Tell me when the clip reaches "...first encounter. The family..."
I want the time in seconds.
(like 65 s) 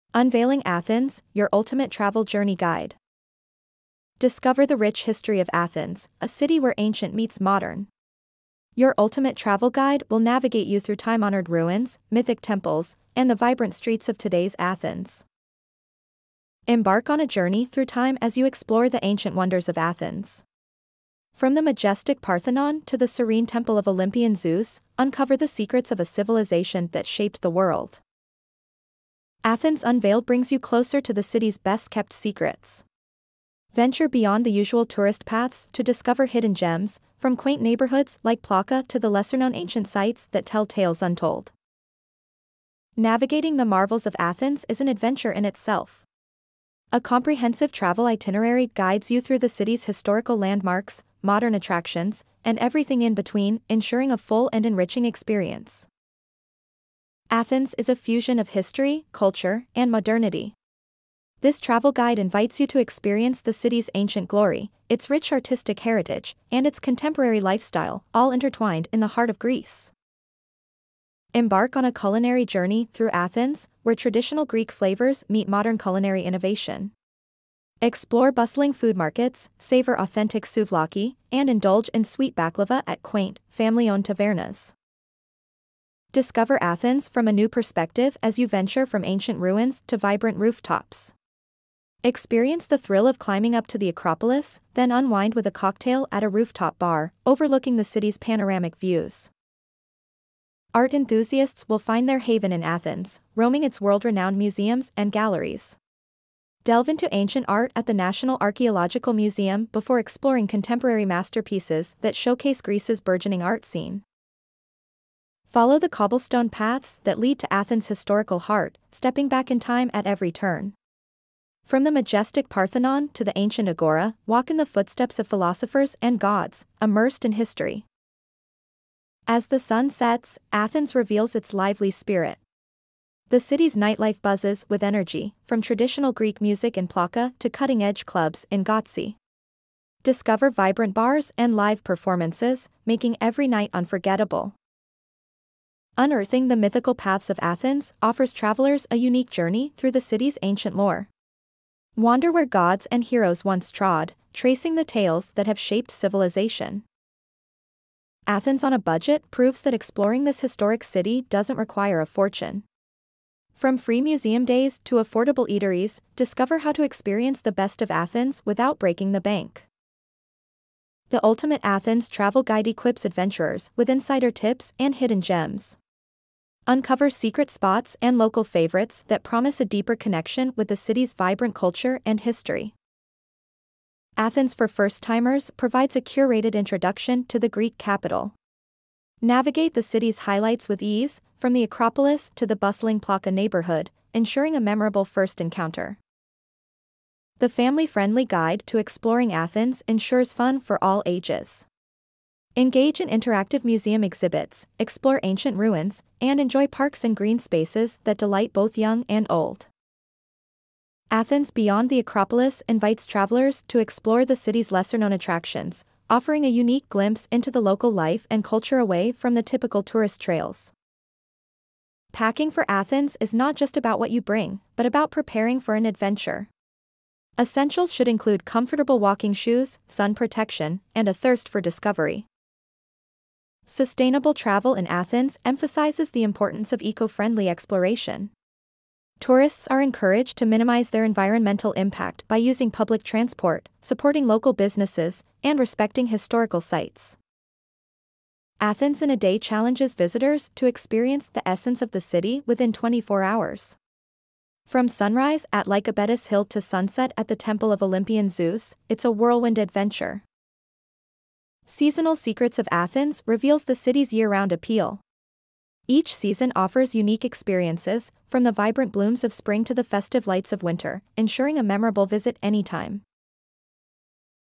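195 s.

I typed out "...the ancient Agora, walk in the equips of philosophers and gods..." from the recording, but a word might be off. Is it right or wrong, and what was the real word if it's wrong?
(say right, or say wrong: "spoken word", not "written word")
wrong: "footsteps", not "equips".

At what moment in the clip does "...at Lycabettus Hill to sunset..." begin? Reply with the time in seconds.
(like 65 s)
255 s.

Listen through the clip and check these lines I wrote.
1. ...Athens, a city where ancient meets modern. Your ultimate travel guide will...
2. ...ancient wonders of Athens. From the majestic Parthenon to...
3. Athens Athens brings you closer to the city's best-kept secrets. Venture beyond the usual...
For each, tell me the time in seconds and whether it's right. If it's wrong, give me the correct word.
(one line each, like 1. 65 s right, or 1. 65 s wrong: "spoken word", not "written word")
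1. 5 s right
2. 19 s right
3. 29 s wrong: "Unveiled", not "Athens".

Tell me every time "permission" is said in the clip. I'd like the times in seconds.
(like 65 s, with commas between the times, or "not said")
not said.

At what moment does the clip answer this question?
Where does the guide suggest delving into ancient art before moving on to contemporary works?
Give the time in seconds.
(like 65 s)
107 s.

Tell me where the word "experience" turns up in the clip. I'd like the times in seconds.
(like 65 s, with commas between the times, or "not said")
55 s, 62 s, 92 s, 166 s, 250 s, 267 s.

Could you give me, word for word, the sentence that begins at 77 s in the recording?
Explore bustling food markets, savor authentic souvlaki, and indulge in sweet baklava at quaint, family-owned tavernas.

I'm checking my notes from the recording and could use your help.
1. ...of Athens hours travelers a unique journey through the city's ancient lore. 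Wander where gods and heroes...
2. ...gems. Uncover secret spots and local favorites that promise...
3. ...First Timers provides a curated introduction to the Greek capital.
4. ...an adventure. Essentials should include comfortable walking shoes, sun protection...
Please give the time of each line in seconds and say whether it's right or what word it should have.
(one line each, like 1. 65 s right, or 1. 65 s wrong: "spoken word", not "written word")
1. 147 s wrong: "offers", not "hours"
2. 175 s right
3. 184 s right
4. 225 s right.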